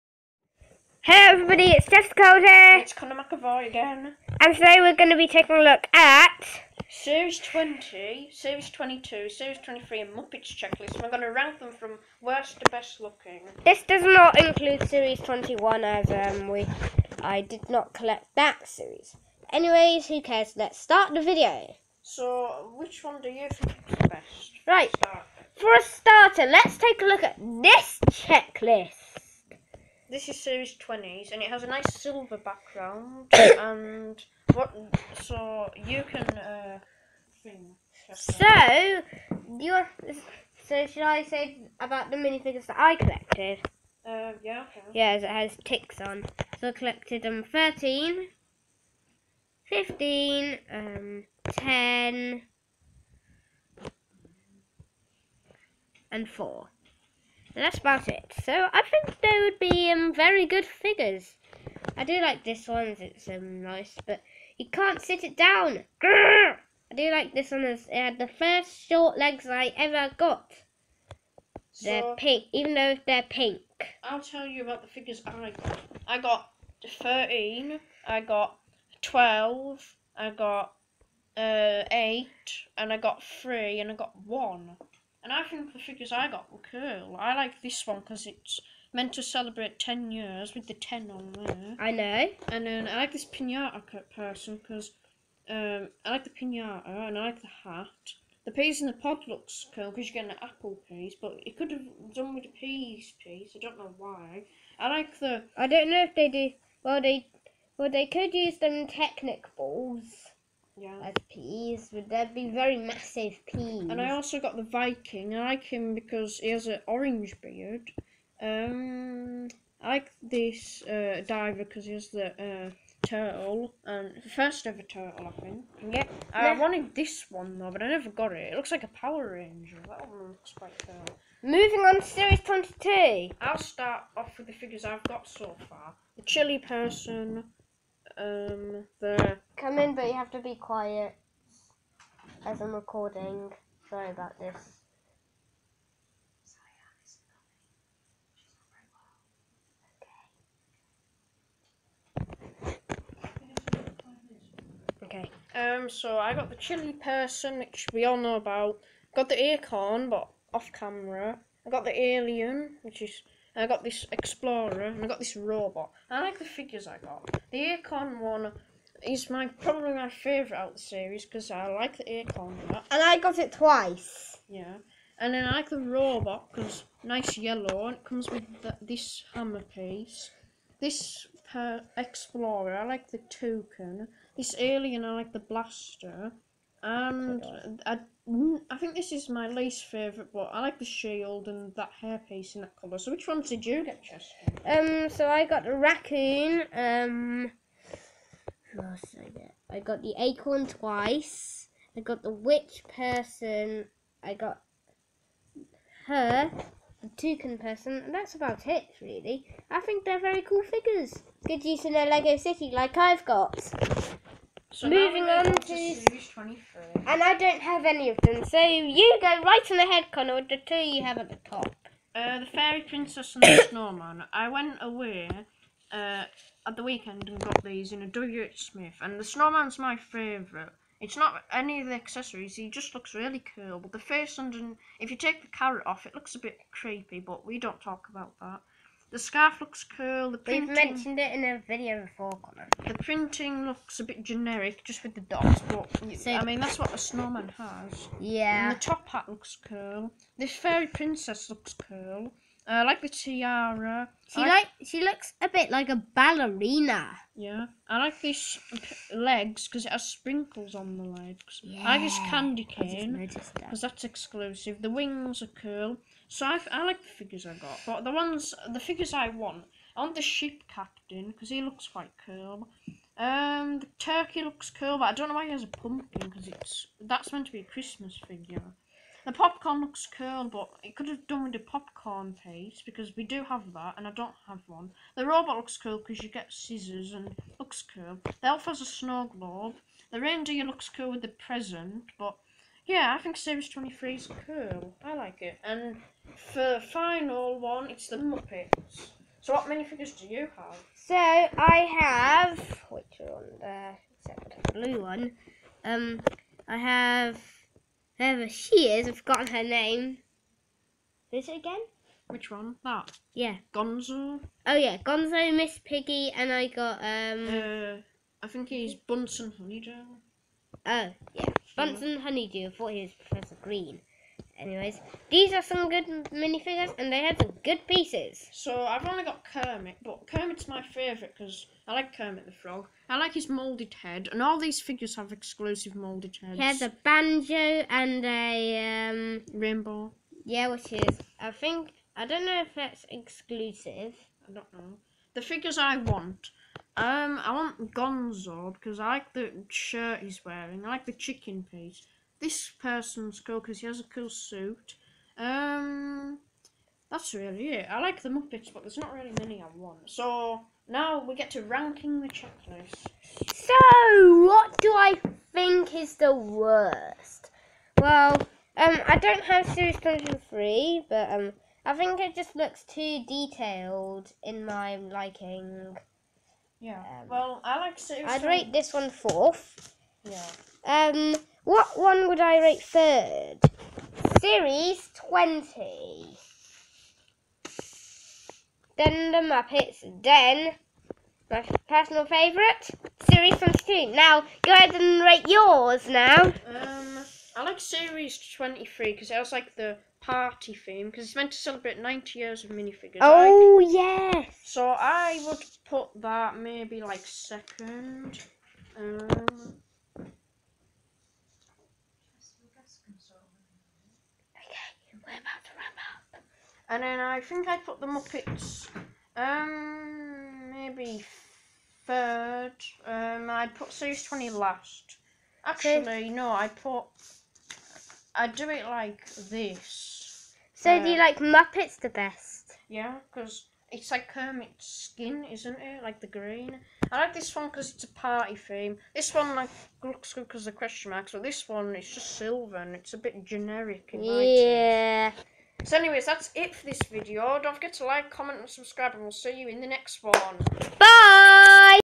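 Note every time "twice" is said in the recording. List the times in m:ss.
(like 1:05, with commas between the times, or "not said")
2:53, 3:20.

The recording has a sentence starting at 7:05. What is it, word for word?
Actually, no, I put I do it like this.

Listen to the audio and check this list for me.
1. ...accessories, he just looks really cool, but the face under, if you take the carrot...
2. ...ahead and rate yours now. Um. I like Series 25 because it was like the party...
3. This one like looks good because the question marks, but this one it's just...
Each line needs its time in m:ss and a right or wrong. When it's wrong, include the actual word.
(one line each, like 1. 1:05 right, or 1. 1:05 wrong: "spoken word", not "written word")
1. 3:51 right
2. 6:34 wrong: "23", not "25"
3. 7:19 right.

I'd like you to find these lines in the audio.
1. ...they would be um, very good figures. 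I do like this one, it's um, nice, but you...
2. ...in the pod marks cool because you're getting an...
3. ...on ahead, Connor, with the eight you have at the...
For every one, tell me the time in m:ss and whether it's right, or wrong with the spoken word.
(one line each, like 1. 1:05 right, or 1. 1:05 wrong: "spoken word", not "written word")
1. 0:59 right
2. 1:38 wrong: "looks", not "marks"
3. 3:39 wrong: "two", not "eight".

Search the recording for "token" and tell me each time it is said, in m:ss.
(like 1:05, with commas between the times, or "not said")
3:03.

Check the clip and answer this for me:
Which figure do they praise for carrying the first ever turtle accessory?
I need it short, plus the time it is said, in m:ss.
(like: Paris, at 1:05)
Diver, at 2:01.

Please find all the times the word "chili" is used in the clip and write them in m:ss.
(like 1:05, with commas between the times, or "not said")
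2:16, 2:36.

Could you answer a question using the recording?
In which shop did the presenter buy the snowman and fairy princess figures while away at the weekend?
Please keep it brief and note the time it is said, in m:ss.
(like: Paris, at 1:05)
WH Smith, at 3:48.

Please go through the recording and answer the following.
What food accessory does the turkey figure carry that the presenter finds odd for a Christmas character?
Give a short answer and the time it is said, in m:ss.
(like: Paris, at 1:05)
Pumpkin, at 4:35.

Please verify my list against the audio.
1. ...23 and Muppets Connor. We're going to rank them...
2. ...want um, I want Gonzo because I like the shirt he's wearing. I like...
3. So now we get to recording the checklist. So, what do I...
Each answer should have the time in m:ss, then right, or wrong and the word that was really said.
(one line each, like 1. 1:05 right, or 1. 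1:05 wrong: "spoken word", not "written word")
1. 0:09 wrong: "Checklist", not "Connor"
2. 5:45 right
3. 6:00 wrong: "ranking", not "recording".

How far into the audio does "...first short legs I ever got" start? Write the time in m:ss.
1:08.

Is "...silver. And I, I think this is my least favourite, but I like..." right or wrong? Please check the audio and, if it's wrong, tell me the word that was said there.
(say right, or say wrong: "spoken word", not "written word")
wrong: "blaster", not "silver".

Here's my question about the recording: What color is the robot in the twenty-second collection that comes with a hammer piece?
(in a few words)
Yellow.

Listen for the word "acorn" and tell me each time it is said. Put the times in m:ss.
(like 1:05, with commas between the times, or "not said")
2:39, 2:47, 2:52, 3:20.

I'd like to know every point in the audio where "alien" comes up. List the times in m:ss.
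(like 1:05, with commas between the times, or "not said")
2:41, 3:04.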